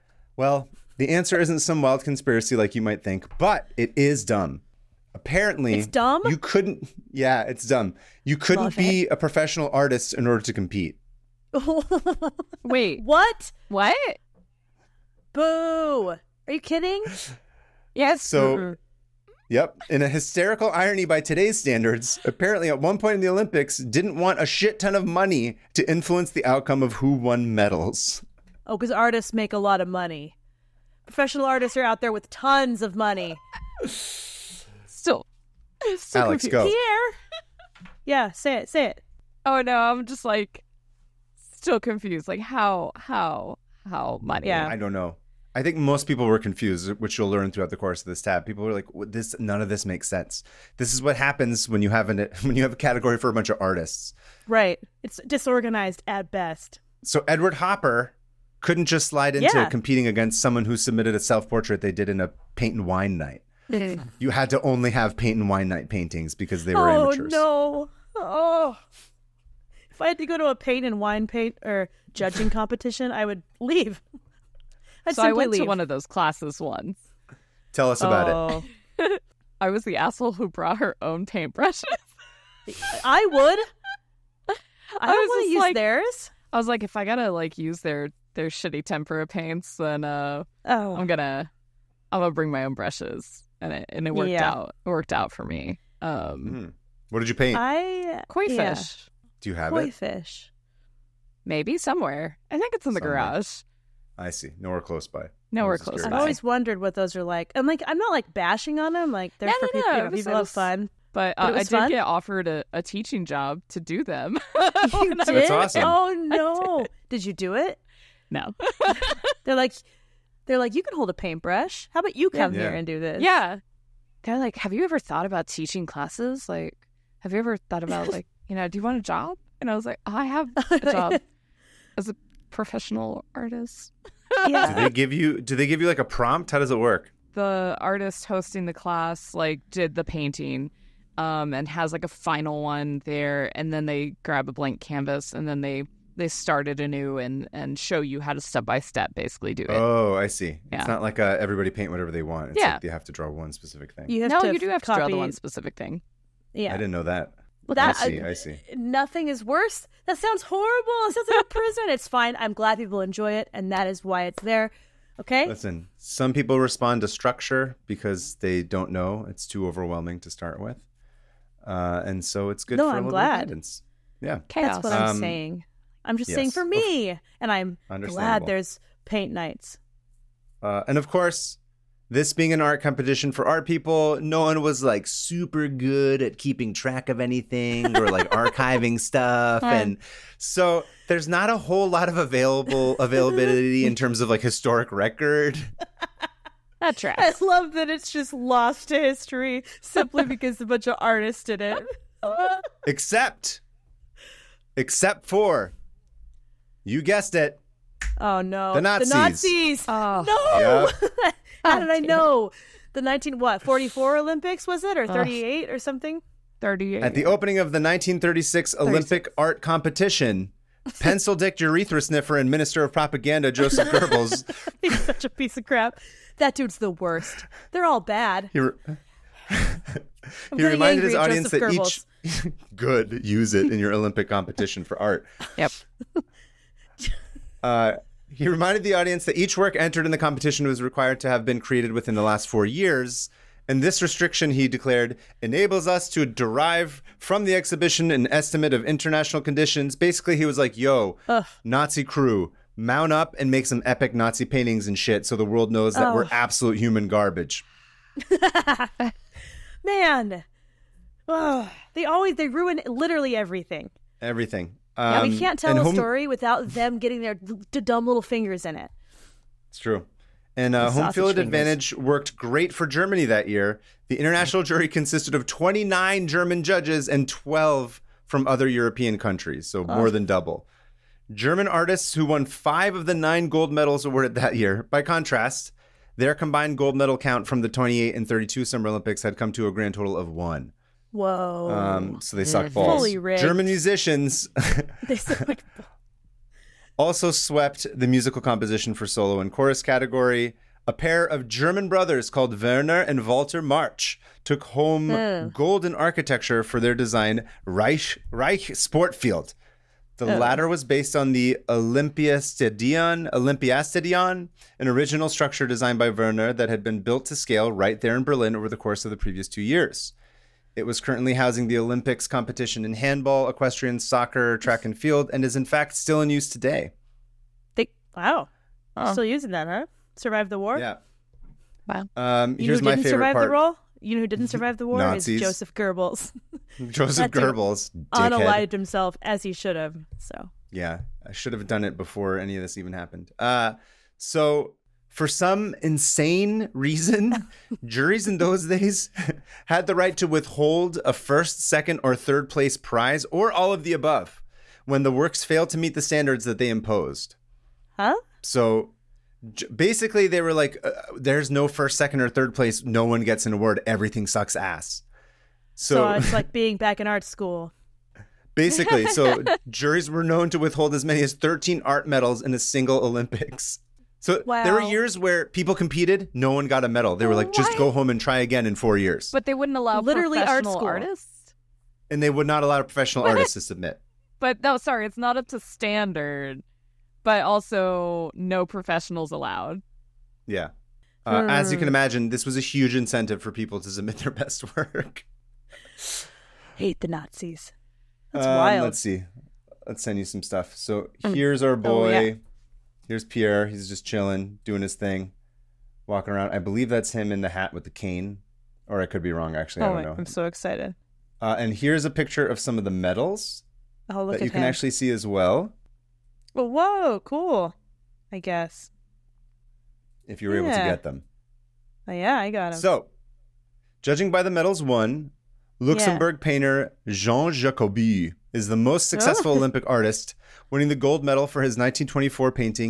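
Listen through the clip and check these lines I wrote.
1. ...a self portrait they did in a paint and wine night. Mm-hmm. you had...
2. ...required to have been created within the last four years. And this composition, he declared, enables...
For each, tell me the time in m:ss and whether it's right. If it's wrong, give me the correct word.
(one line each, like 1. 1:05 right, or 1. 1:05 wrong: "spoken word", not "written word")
1. 1:01 right
2. 4:00 wrong: "restriction", not "composition".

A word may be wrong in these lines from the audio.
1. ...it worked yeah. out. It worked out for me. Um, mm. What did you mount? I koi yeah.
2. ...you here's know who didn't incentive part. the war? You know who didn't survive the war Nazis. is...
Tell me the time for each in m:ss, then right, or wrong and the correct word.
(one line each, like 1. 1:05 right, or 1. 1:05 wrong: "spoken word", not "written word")
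1. 1:34 wrong: "paint", not "mount"
2. 5:32 wrong: "survive", not "incentive".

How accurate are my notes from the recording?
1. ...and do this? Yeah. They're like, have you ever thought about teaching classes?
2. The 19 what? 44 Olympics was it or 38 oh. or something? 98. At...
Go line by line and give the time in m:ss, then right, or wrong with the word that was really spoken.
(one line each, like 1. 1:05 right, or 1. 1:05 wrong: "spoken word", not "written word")
1. 2:02 right
2. 3:32 wrong: "38", not "98".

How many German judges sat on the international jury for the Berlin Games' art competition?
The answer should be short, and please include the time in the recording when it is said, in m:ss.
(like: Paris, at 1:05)
29, at 4:35.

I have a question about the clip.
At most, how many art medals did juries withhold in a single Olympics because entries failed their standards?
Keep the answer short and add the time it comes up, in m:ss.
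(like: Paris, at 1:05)
13, at 6:11.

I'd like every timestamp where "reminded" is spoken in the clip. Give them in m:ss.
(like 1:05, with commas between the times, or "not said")
3:50, 3:58.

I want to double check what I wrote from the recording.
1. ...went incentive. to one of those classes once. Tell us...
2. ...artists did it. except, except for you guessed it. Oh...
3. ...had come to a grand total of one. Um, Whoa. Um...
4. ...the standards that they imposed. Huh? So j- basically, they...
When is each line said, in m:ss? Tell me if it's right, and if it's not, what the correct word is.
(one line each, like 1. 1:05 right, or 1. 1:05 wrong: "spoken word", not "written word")
1. 1:15 wrong: "leave", not "incentive"
2. 3:20 right
3. 4:49 right
4. 5:55 right.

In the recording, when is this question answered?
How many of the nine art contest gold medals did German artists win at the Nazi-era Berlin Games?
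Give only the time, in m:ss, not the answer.
4:42.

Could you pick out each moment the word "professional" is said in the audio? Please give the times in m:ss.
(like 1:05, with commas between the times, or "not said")
0:09, 0:31, 2:12, 6:22, 6:28.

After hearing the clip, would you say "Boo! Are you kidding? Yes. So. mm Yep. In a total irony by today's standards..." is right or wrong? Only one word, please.
wrong.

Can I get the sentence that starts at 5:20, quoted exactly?
It was currently housing the Olympics competition in handball, equestrian, soccer, track and field, and is in fact still in use today.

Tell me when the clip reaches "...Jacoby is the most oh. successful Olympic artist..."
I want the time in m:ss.
7:07.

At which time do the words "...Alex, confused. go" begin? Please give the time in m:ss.
0:36.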